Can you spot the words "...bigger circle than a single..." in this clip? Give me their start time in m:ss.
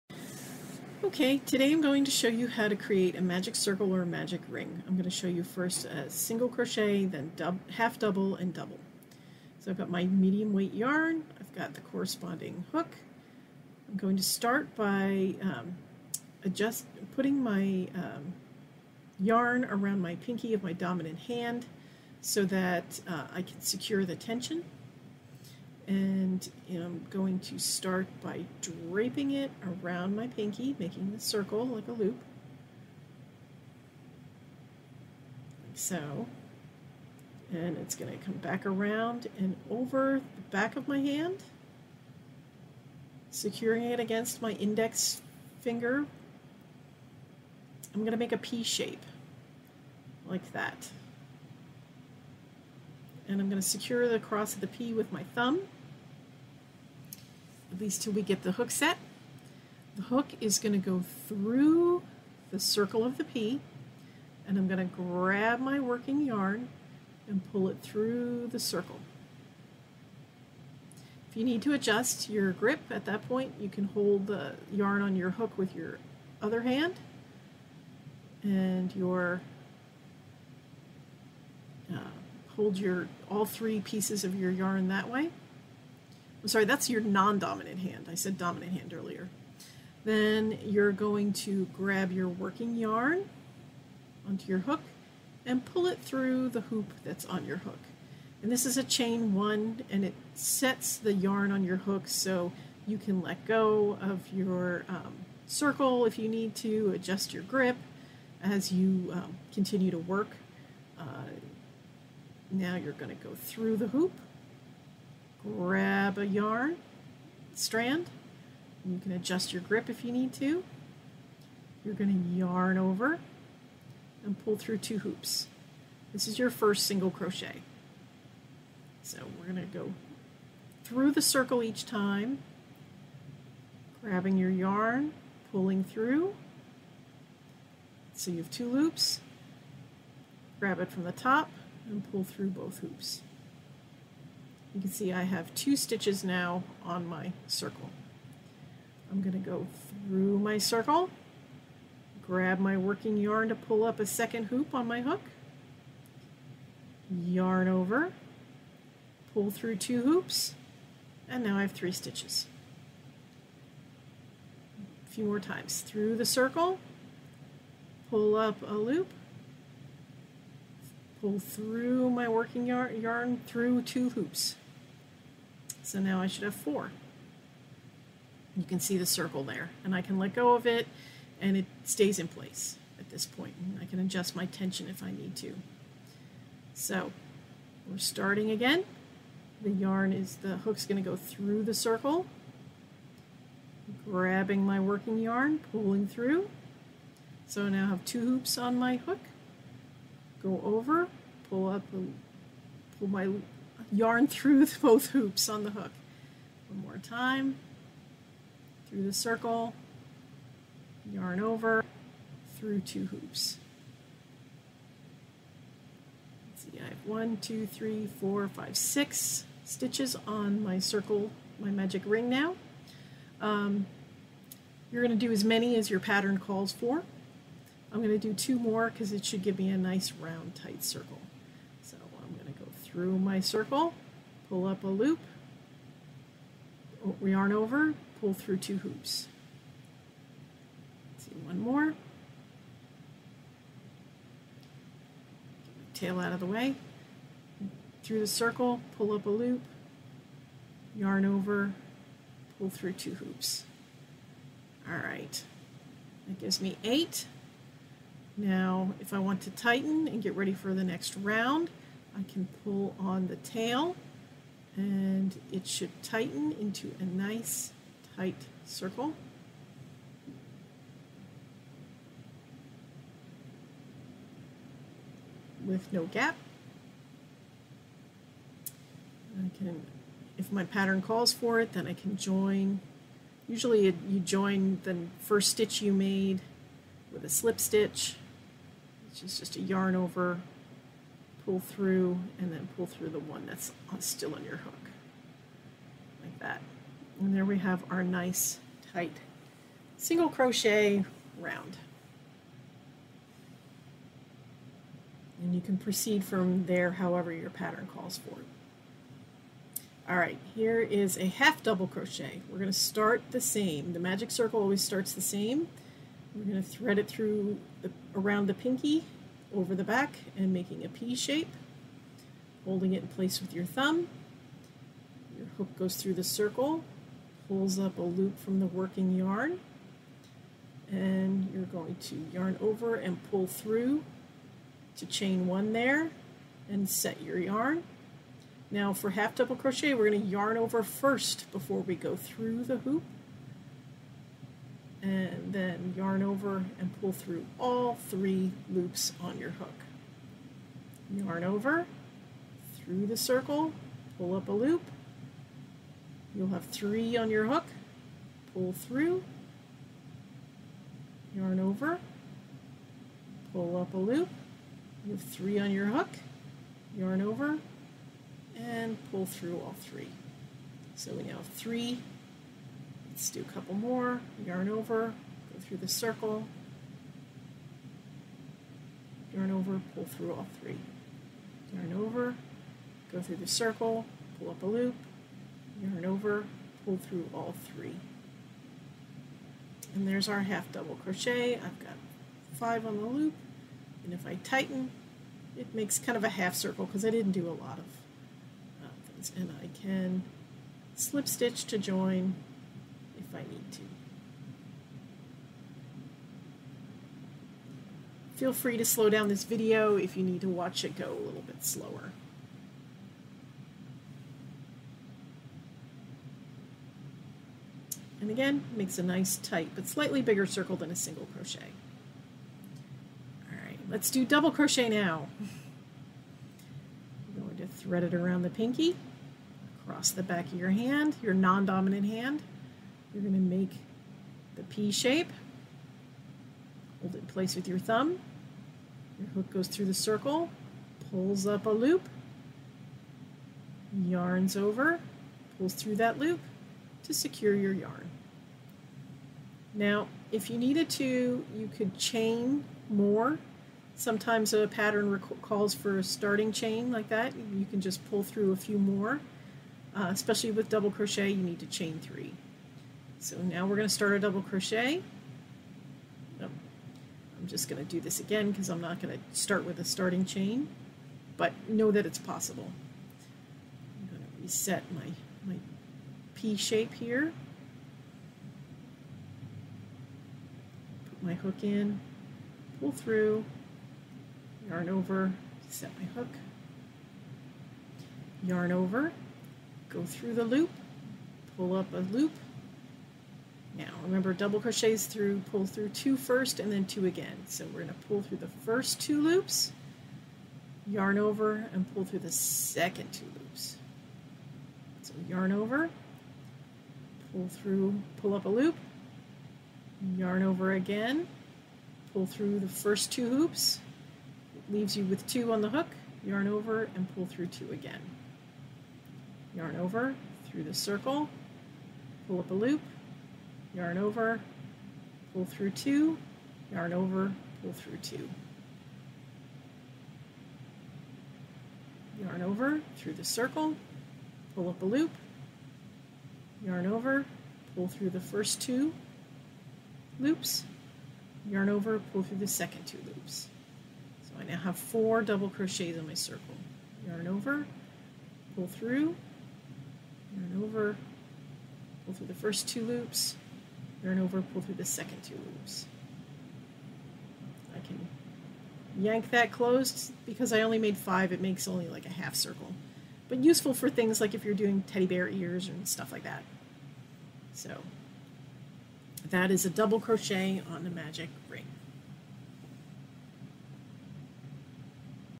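7:00.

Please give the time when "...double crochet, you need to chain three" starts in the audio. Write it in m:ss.
7:40.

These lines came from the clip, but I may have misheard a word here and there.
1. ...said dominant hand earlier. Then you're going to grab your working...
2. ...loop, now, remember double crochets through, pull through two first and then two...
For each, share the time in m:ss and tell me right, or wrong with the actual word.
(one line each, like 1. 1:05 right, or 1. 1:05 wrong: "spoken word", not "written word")
1. 1:28 right
2. 8:11 right.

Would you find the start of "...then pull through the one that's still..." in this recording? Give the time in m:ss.
4:52.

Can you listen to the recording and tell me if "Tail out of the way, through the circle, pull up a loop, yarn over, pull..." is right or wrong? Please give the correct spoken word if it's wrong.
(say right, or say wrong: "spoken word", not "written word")
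right.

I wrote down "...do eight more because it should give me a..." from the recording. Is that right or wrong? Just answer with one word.
wrong.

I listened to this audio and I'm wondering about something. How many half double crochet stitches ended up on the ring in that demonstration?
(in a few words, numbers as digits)
5.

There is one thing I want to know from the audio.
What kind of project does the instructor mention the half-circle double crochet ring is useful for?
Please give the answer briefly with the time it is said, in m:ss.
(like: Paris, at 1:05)
teddy bear ears, at 9:24.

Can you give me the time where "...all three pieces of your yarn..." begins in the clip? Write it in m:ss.
1:23.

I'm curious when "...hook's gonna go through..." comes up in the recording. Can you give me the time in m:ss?
3:10.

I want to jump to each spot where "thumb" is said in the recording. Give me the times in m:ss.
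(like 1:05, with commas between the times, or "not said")
0:55, 5:23, 7:17.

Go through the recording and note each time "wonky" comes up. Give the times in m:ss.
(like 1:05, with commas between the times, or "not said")
not said.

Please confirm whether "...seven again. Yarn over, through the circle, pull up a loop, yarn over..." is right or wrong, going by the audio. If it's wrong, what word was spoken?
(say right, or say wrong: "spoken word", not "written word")
wrong: "two", not "seven".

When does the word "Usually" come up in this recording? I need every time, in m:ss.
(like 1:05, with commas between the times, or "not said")
4:43.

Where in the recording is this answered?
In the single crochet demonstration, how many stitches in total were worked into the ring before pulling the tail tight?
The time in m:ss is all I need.
4:16.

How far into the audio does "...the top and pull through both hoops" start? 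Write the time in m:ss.
2:21.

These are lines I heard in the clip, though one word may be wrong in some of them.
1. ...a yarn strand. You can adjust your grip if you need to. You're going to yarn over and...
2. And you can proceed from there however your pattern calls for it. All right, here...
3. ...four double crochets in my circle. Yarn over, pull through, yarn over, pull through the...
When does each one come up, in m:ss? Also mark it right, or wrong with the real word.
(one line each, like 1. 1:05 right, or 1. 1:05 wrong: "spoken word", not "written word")
1. 1:56 right
2. 5:05 right
3. 9:04 right.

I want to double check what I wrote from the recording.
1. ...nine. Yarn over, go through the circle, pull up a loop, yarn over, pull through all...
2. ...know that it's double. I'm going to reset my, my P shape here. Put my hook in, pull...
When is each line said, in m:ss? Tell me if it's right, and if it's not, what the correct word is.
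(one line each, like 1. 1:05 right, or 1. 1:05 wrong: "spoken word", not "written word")
1. 6:20 wrong: "three", not "nine"
2. 7:51 wrong: "possible", not "double".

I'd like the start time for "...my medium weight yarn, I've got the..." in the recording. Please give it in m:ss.
0:09.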